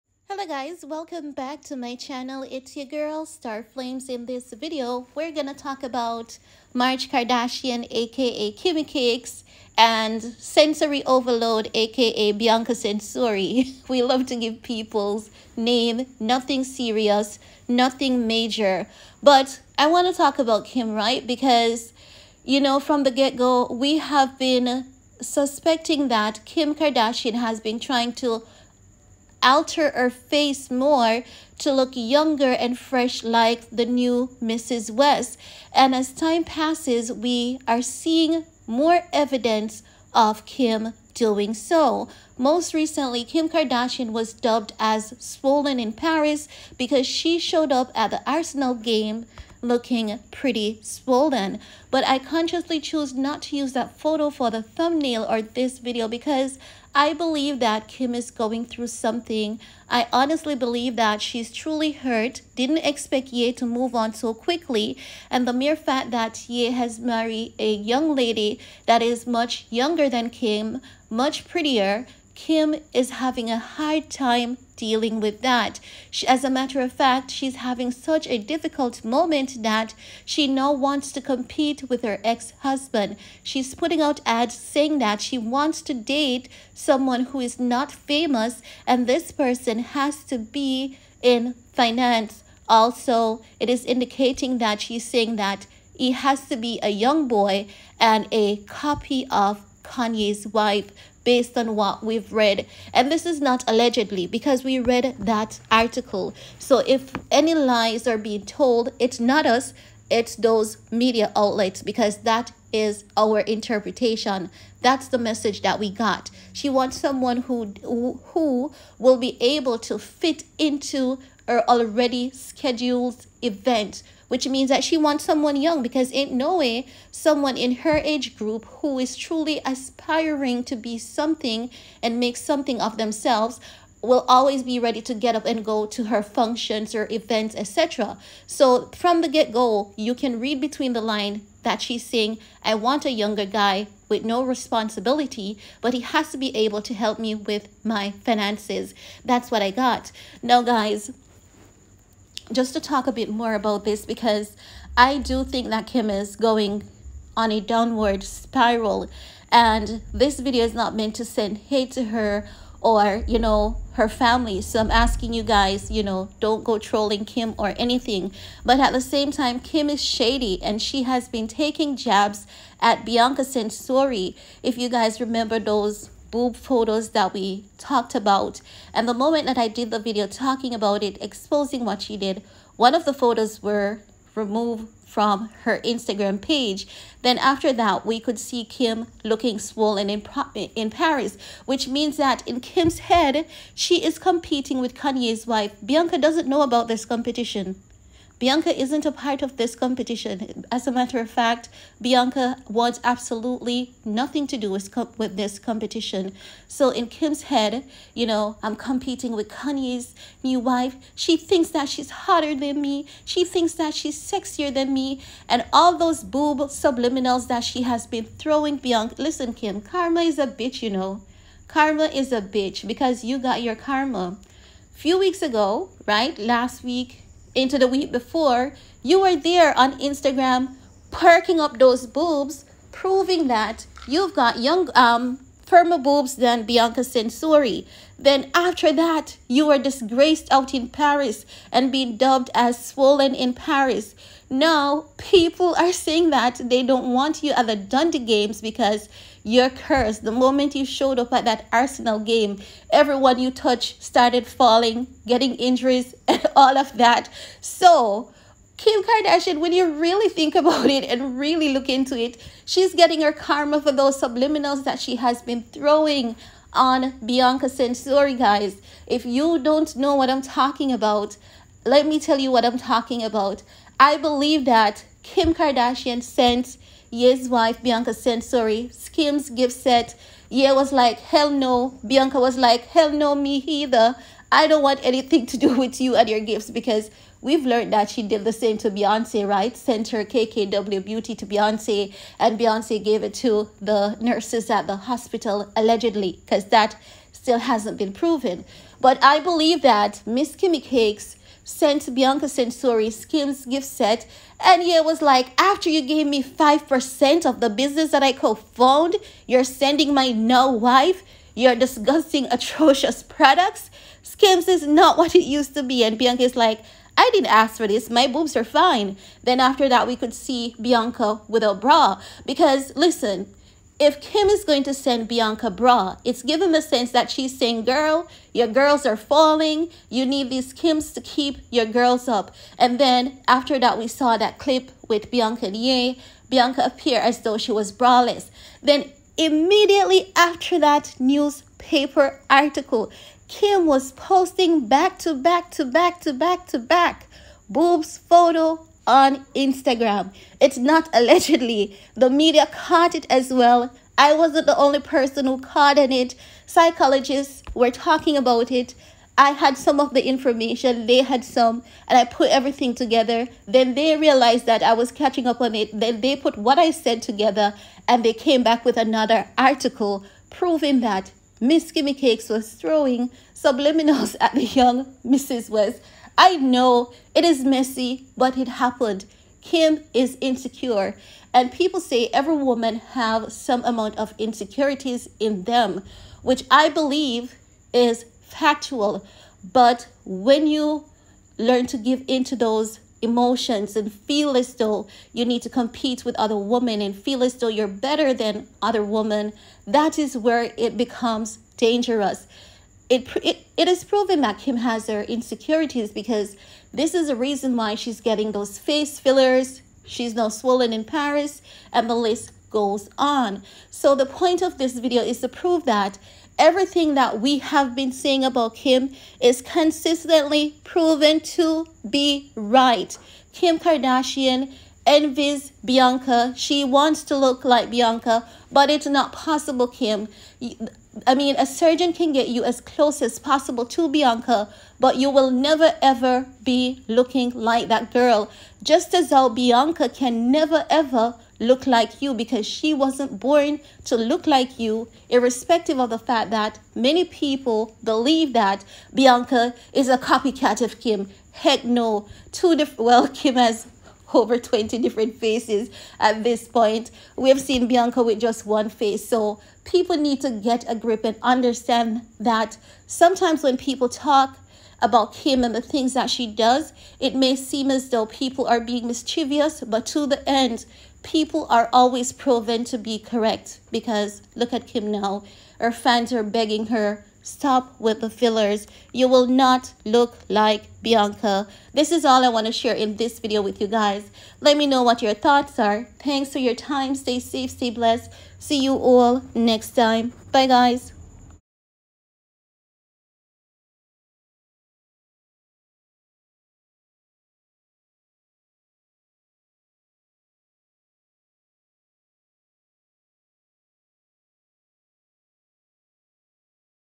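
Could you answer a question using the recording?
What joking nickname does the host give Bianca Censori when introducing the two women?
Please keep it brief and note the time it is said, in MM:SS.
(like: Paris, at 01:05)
Censori Overload, at 00:10.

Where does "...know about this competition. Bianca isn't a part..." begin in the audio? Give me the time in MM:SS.
03:16.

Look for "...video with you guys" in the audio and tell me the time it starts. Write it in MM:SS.
08:03.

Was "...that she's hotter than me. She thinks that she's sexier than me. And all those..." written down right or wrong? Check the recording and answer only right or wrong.
right.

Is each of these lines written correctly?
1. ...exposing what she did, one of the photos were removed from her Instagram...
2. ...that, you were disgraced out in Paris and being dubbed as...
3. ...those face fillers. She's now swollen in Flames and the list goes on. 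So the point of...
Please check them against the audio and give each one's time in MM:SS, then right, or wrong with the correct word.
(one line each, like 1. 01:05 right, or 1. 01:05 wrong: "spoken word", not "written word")
1. 03:01 right
2. 03:58 right
3. 06:48 wrong: "Paris", not "Flames".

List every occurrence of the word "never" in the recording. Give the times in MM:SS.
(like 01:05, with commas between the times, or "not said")
07:15, 07:20.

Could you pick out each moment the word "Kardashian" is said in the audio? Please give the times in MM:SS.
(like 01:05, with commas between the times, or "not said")
00:07, 00:26, 00:43, 04:19, 04:35, 07:03.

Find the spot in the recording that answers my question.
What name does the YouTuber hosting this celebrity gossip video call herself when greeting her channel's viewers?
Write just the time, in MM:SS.
00:03.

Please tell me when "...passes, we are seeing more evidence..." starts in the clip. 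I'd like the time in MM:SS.
00:36.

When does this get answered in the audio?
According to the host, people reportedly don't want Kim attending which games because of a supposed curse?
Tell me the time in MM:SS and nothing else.
04:07.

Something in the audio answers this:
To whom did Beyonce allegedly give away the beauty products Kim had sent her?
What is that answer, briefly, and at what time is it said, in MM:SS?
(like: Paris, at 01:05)
the nurses at the hospital, at 04:53.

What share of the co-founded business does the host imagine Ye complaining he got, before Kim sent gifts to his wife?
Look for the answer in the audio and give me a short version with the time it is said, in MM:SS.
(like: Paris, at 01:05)
5%, at 05:06.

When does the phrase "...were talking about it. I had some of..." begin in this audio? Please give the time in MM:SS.
05:57.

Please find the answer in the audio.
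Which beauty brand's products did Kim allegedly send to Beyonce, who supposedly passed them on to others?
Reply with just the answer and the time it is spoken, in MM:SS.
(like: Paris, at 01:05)
KKW Beauty, at 04:50.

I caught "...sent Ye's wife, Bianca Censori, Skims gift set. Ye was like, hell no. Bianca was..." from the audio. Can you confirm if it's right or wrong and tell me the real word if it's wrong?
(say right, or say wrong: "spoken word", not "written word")
right.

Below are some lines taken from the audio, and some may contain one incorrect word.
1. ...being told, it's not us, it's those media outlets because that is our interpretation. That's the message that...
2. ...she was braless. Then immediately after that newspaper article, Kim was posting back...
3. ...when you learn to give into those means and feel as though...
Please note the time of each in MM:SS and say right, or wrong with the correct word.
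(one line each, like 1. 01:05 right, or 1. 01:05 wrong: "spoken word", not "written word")
1. 01:48 right
2. 05:37 right
3. 06:30 wrong: "emotions", not "means".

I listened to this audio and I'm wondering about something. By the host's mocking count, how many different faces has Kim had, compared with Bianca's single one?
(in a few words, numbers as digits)
over 20.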